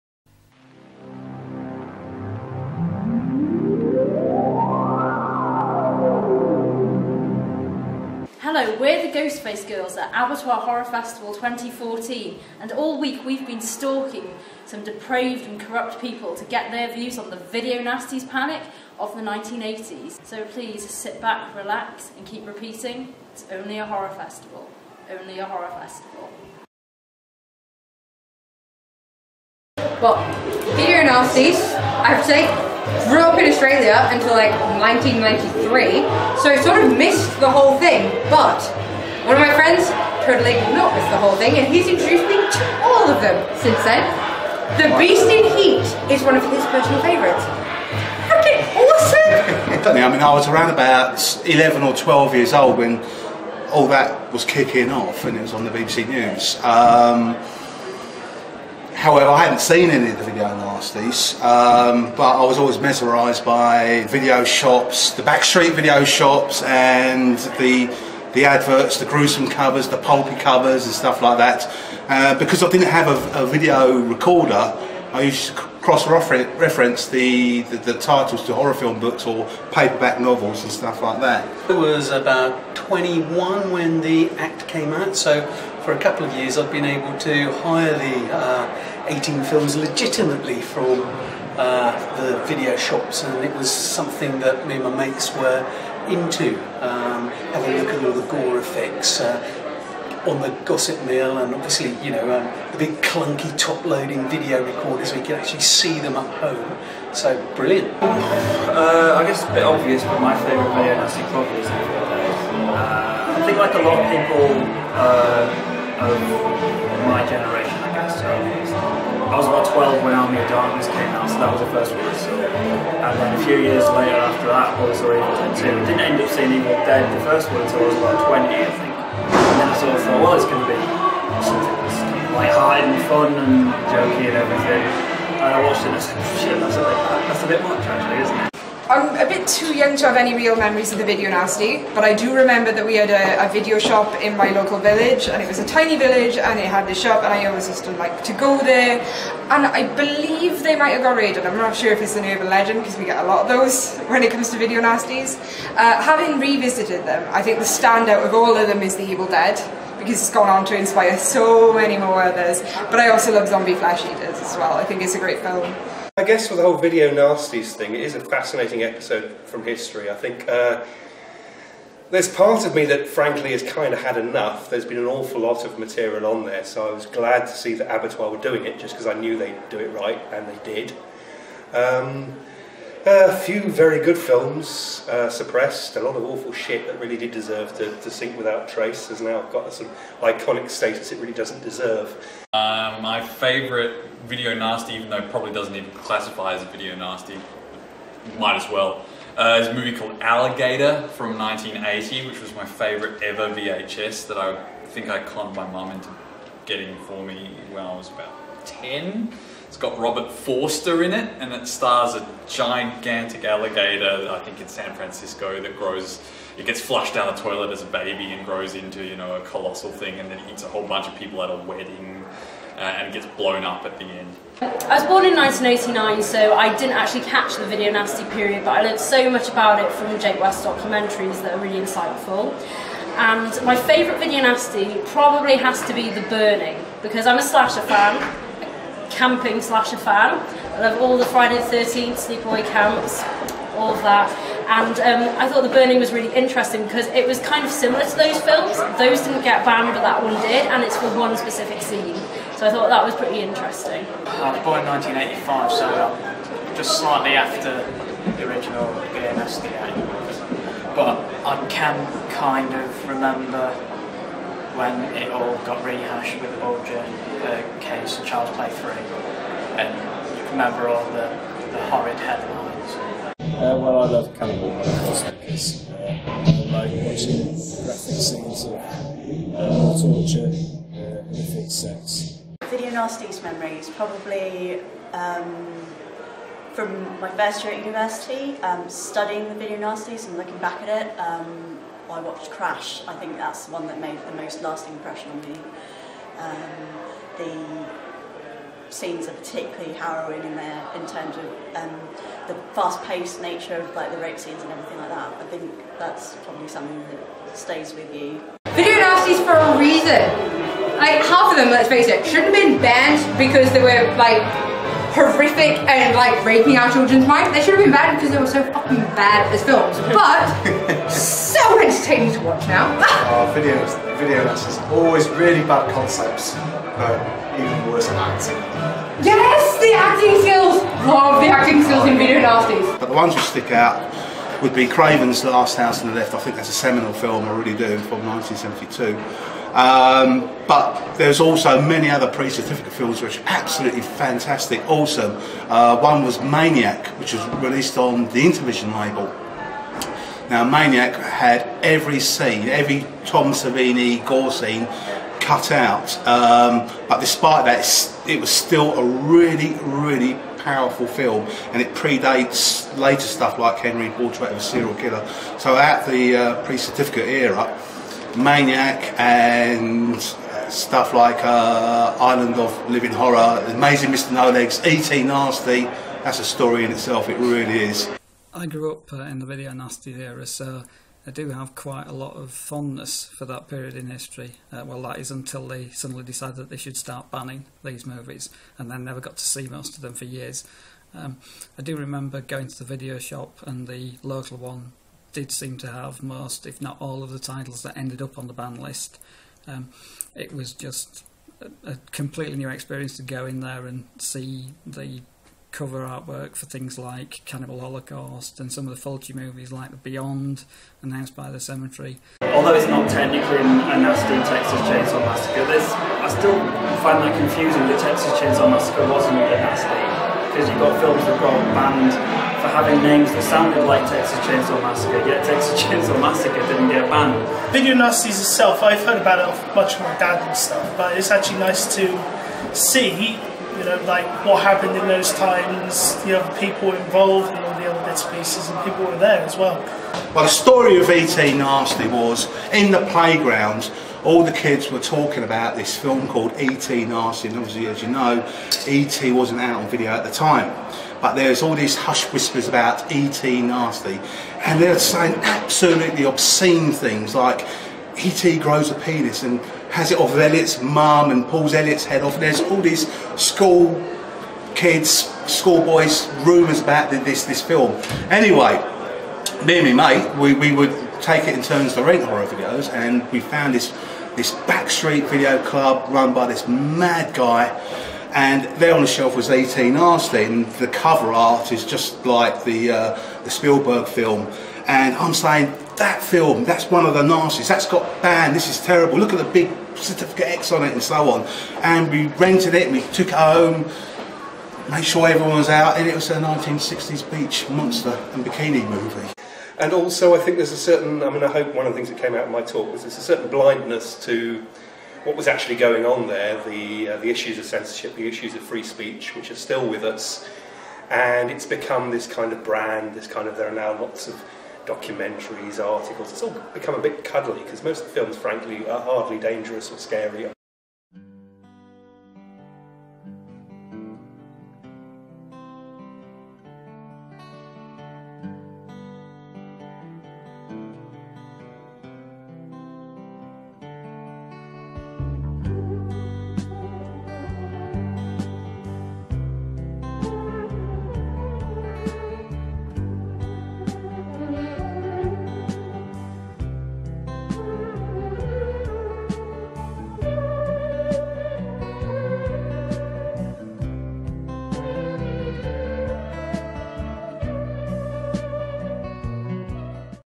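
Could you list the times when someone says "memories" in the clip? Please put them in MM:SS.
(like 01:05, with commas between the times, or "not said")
02:20, 04:43.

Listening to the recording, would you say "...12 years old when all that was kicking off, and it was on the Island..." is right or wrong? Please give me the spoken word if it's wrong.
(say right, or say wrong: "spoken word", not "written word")
wrong: "BBC", not "Island".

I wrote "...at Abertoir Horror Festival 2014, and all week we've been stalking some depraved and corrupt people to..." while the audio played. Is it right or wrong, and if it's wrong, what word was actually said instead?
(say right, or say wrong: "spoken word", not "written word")
right.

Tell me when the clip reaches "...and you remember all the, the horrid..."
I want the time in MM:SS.
04:29.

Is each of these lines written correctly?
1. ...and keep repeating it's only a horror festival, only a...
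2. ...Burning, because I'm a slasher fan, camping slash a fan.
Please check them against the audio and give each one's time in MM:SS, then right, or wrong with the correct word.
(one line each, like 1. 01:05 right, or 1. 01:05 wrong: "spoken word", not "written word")
1. 00:22 right
2. 03:56 right.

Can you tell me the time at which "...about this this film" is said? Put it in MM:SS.
07:46.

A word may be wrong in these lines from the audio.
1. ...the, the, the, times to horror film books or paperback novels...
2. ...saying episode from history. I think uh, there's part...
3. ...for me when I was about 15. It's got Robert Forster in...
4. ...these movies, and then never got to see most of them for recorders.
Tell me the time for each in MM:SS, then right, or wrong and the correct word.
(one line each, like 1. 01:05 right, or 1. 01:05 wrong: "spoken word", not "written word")
1. 01:17 wrong: "titles", not "times"
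2. 02:48 wrong: "fascinating", not "saying"
3. 03:27 wrong: "10", not "15"
4. 06:27 wrong: "years", not "recorders".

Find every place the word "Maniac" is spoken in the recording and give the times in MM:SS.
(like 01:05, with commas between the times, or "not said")
05:46, 05:50, 06:08.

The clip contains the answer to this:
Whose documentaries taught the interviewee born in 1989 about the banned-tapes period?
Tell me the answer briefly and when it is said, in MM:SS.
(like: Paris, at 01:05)
Jake West, at 03:50.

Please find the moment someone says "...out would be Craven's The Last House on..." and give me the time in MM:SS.
05:33.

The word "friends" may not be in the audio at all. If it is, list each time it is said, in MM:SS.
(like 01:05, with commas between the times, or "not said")
00:39.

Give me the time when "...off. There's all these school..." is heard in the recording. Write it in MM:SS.
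07:42.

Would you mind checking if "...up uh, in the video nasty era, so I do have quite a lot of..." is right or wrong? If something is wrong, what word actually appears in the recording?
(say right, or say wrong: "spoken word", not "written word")
right.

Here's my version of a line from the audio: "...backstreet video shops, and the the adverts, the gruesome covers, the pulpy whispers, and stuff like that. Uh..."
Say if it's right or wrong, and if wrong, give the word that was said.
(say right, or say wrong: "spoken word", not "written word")
wrong: "covers", not "whispers".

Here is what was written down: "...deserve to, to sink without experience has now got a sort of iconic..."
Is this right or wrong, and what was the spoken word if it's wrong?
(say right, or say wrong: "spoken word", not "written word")
wrong: "trace", not "experience".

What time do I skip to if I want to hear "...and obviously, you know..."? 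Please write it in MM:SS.
01:41.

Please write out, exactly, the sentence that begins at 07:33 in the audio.
nasty, and they're saying absolutely obscene things like E.T.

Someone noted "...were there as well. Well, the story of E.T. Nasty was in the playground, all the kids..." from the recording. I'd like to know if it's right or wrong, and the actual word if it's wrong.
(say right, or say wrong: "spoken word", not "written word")
right.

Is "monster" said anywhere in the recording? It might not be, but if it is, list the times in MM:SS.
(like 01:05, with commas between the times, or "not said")
08:17.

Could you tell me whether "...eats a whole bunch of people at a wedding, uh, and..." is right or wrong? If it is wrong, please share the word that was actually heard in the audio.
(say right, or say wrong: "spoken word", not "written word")
right.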